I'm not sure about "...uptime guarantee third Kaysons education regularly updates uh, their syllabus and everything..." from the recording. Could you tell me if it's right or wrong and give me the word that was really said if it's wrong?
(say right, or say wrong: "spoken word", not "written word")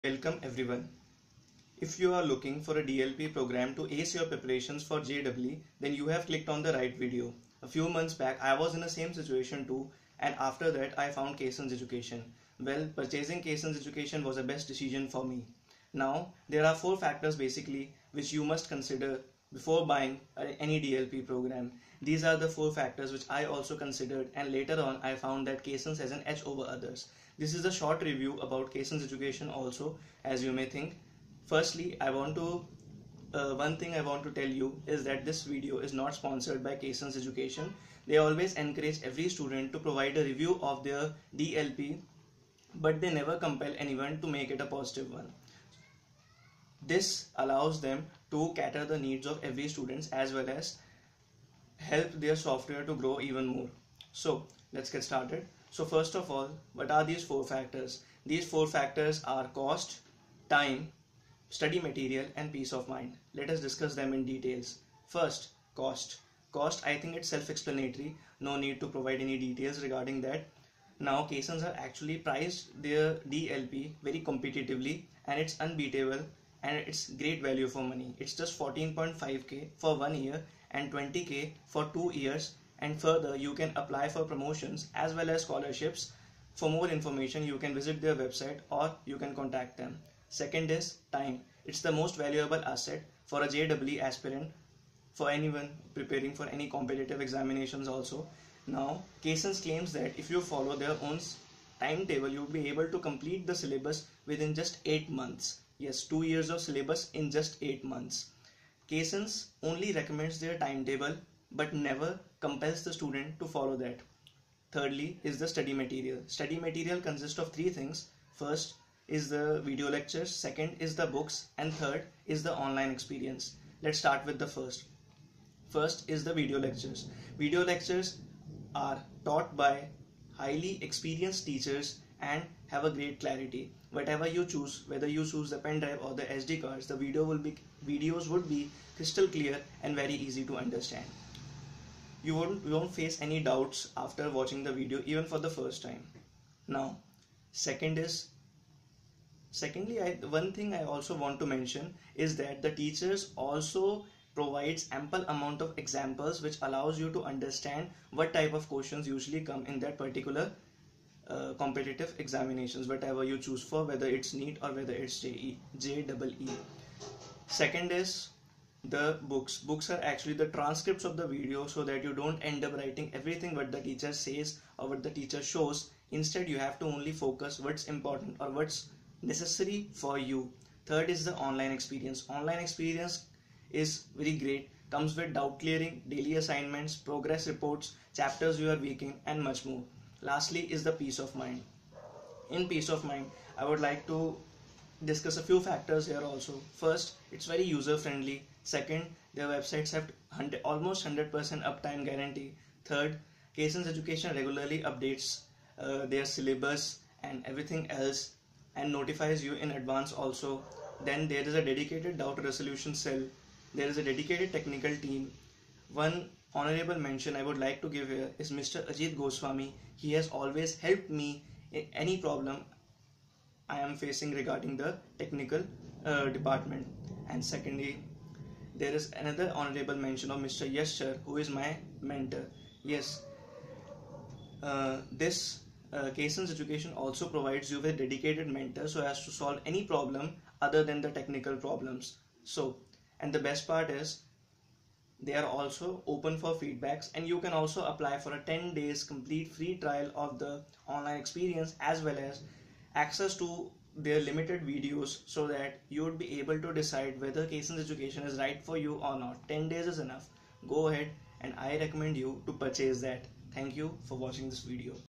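right.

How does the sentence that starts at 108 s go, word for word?
Kaysons only recommends their timetable but never compels the student to follow that.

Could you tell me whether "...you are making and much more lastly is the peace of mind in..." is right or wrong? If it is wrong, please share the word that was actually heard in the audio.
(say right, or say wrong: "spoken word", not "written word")
right.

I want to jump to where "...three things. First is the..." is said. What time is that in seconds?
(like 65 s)
117 s.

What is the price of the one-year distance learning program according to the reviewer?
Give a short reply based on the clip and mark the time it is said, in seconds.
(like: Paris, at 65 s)
14.5k, at 78 s.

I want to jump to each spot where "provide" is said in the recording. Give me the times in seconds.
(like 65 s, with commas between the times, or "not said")
39 s, 68 s, 154 s, 237 s.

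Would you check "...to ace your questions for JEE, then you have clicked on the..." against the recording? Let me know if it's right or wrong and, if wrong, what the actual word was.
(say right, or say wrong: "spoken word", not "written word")
wrong: "preparations", not "questions".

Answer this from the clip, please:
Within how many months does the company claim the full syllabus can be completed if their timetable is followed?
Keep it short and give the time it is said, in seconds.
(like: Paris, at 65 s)
8 months, at 104 s.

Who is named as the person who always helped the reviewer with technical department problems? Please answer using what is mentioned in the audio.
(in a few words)
Ajit Goswami.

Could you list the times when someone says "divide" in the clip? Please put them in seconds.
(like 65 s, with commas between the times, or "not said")
not said.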